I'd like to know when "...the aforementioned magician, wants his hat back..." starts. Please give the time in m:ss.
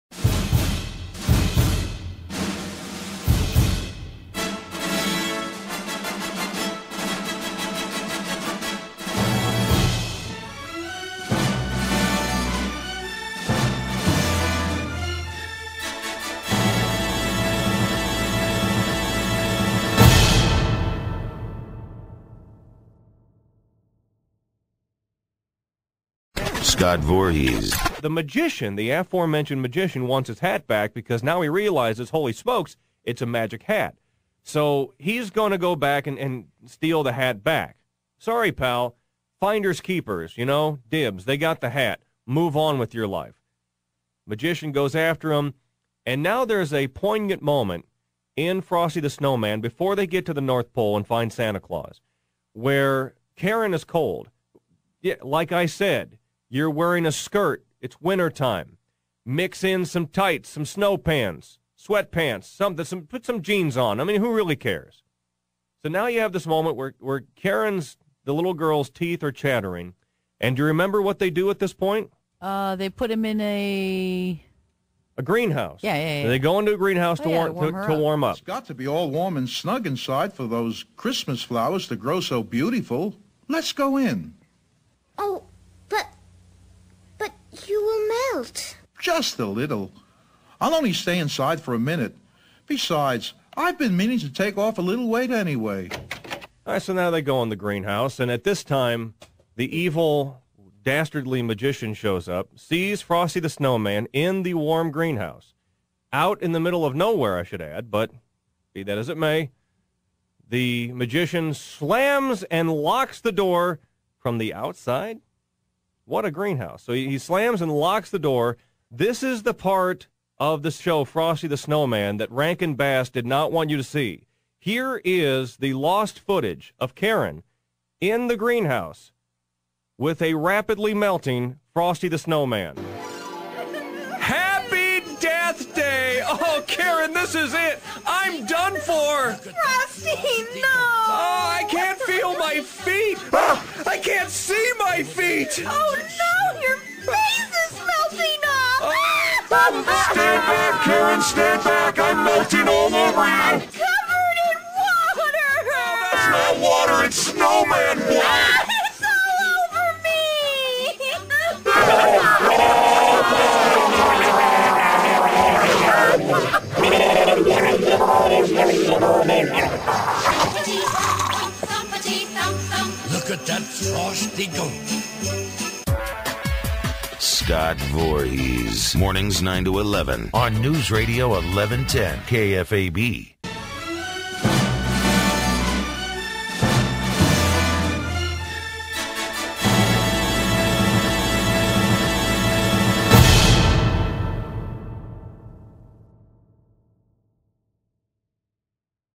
0:28.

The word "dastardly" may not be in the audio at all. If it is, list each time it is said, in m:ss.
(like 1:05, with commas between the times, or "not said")
1:40.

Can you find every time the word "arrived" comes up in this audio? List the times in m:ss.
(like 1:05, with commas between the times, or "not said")
not said.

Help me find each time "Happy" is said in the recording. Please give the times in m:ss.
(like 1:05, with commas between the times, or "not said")
2:14.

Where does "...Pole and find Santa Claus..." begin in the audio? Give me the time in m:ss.
0:50.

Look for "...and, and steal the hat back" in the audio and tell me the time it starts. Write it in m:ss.
0:36.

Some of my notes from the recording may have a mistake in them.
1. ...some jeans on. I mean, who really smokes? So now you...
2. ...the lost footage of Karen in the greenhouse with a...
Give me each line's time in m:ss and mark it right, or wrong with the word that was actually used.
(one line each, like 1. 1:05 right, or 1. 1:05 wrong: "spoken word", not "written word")
1. 1:03 wrong: "cares", not "smokes"
2. 2:05 right.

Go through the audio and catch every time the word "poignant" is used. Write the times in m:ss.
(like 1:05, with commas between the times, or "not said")
0:46.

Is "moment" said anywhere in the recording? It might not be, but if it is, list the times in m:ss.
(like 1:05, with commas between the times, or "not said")
0:47, 1:06.